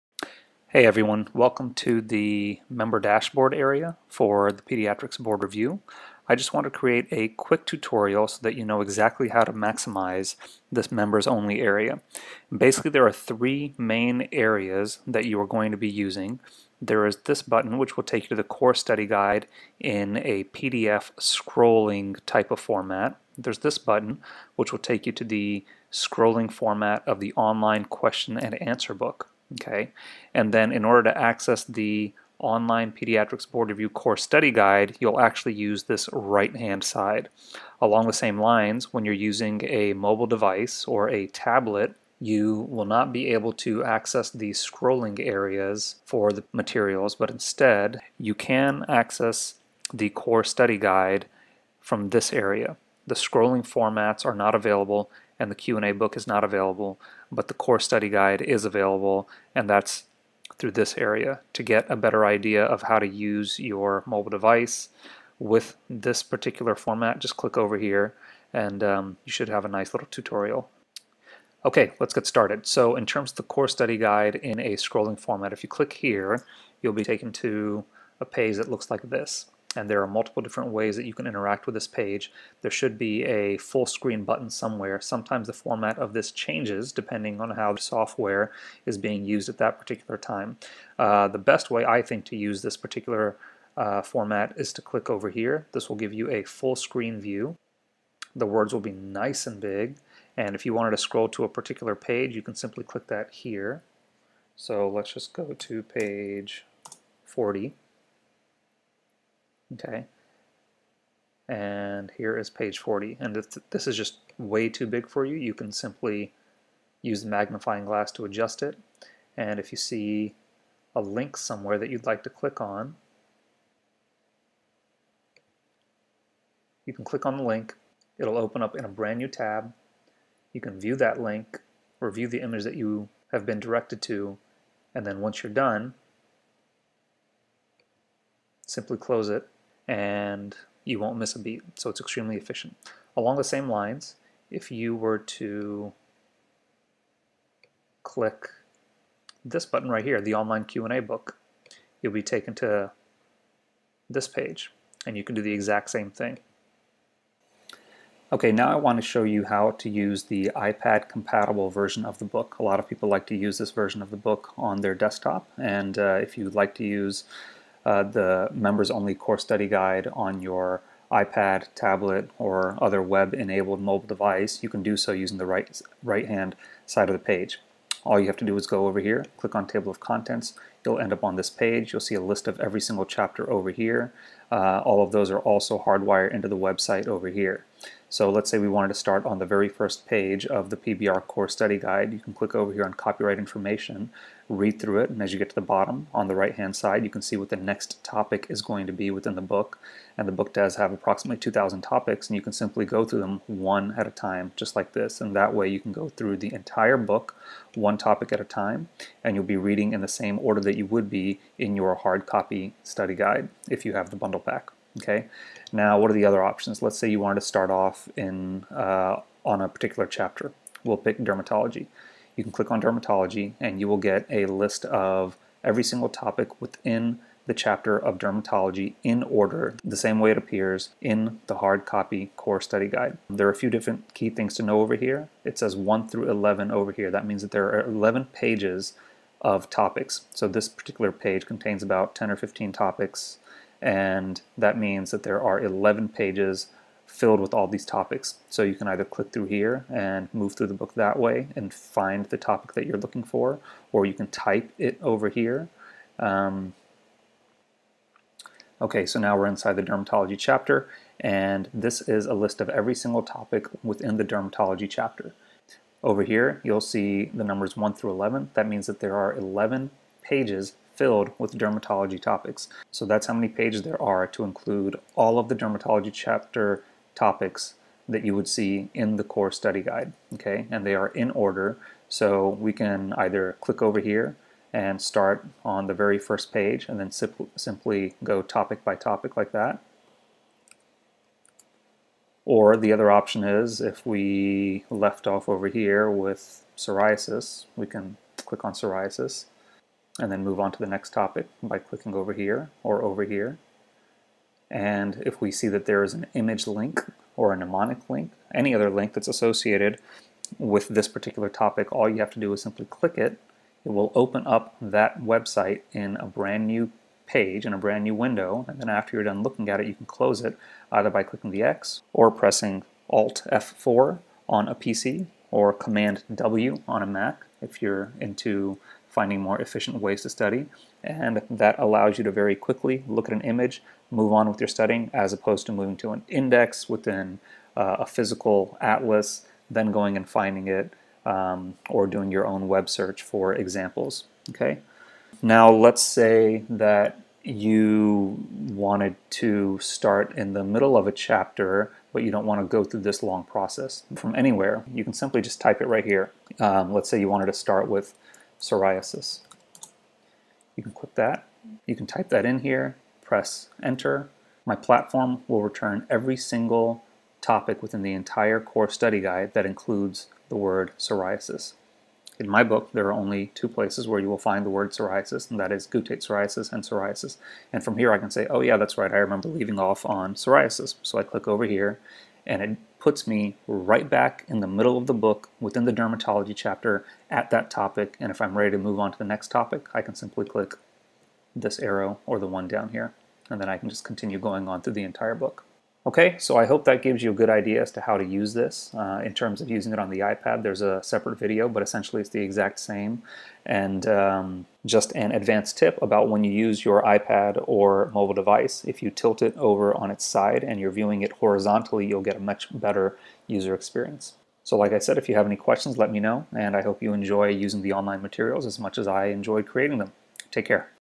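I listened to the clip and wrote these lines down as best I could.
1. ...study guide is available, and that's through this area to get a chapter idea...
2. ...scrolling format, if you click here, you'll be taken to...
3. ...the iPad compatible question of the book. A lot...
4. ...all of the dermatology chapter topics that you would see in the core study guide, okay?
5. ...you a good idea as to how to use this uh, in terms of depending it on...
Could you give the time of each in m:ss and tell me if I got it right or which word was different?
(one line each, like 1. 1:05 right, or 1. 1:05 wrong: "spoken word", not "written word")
1. 0:57 wrong: "better", not "chapter"
2. 1:14 right
3. 2:40 wrong: "version", not "question"
4. 4:35 right
5. 6:37 wrong: "using", not "depending".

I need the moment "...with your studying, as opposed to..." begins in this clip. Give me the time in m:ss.
5:34.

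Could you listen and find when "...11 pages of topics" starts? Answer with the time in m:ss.
3:57.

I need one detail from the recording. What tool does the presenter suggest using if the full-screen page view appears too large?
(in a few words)
magnifying glass.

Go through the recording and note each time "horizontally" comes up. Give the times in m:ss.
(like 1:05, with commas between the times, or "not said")
6:51.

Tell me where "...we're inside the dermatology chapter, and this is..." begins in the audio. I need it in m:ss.
4:19.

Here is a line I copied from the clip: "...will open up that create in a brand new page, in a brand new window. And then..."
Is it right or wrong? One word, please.
wrong.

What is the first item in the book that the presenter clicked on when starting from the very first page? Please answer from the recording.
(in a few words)
Copyright Information.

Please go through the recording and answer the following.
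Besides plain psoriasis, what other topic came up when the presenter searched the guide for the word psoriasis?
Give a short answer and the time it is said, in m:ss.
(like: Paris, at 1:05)
guttate psoriasis, at 6:15.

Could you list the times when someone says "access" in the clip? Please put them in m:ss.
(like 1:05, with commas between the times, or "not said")
0:31, 0:43, 0:48.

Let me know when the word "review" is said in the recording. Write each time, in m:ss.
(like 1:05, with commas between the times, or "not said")
0:05, 0:33, 2:11.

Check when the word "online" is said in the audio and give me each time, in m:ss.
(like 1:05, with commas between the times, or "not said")
0:27, 0:32, 2:30, 6:57.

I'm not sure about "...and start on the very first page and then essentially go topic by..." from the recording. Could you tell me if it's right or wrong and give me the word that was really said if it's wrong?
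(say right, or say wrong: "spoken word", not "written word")
wrong: "simply", not "essentially".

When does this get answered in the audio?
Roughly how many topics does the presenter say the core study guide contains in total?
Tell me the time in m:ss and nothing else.
3:21.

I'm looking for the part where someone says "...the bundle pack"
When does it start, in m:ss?
3:34.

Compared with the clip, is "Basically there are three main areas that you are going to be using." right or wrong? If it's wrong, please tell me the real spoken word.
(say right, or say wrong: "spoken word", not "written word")
right.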